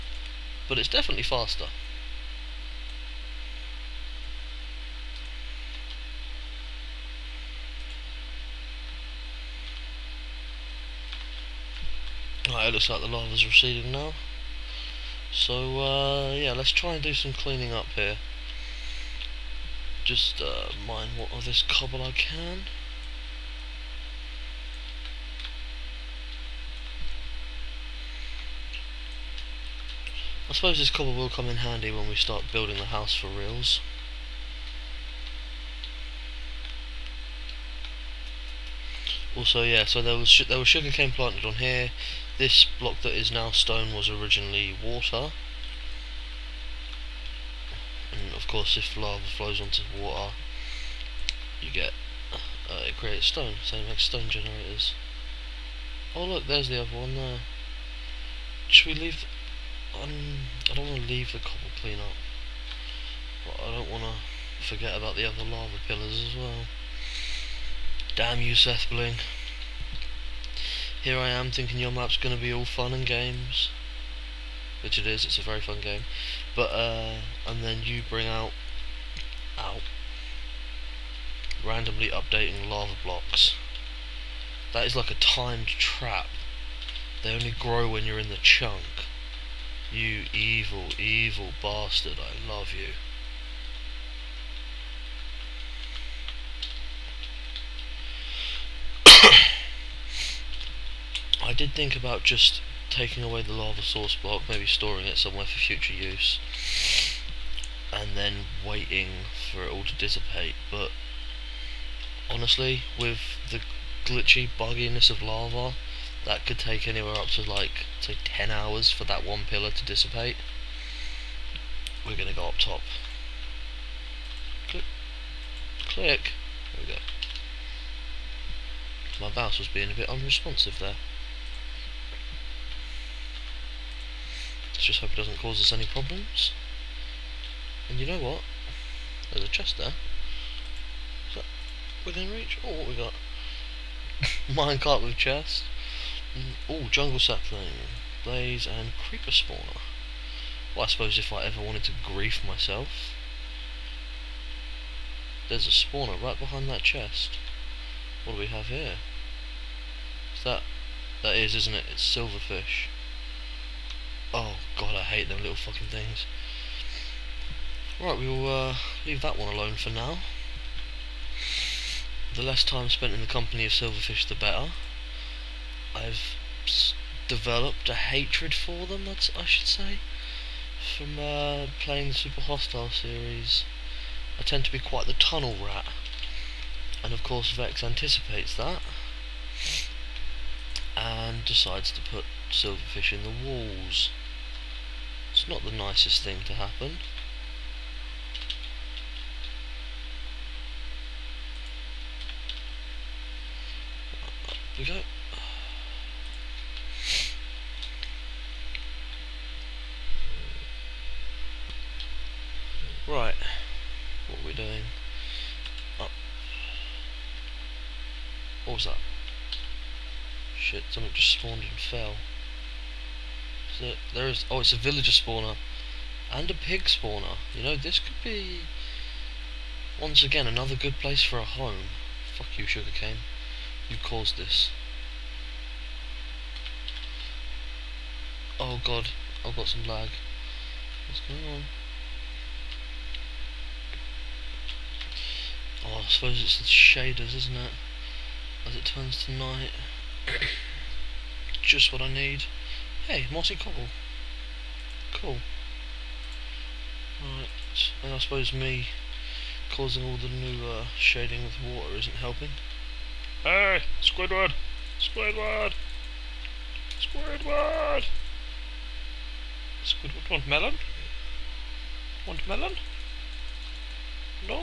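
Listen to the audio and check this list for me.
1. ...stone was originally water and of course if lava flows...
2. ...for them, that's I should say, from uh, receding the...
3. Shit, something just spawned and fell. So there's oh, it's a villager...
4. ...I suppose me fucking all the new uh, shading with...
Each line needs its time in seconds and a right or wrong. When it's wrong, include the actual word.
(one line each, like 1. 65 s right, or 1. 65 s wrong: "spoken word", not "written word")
1. 43 s right
2. 178 s wrong: "playing", not "receding"
3. 220 s right
4. 258 s wrong: "causing", not "fucking".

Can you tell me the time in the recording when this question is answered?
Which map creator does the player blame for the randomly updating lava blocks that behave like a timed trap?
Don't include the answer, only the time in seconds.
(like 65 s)
68 s.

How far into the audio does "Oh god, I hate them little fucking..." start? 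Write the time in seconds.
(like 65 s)
164 s.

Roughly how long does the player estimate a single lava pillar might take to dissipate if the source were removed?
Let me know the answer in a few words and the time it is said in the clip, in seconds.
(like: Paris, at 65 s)
10 hours, at 118 s.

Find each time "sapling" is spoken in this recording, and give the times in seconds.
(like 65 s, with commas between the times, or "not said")
147 s.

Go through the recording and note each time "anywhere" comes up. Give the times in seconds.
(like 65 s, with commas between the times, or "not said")
116 s.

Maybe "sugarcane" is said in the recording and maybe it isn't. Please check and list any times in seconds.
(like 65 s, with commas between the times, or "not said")
40 s, 232 s.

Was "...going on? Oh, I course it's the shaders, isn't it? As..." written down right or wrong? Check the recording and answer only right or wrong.
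wrong.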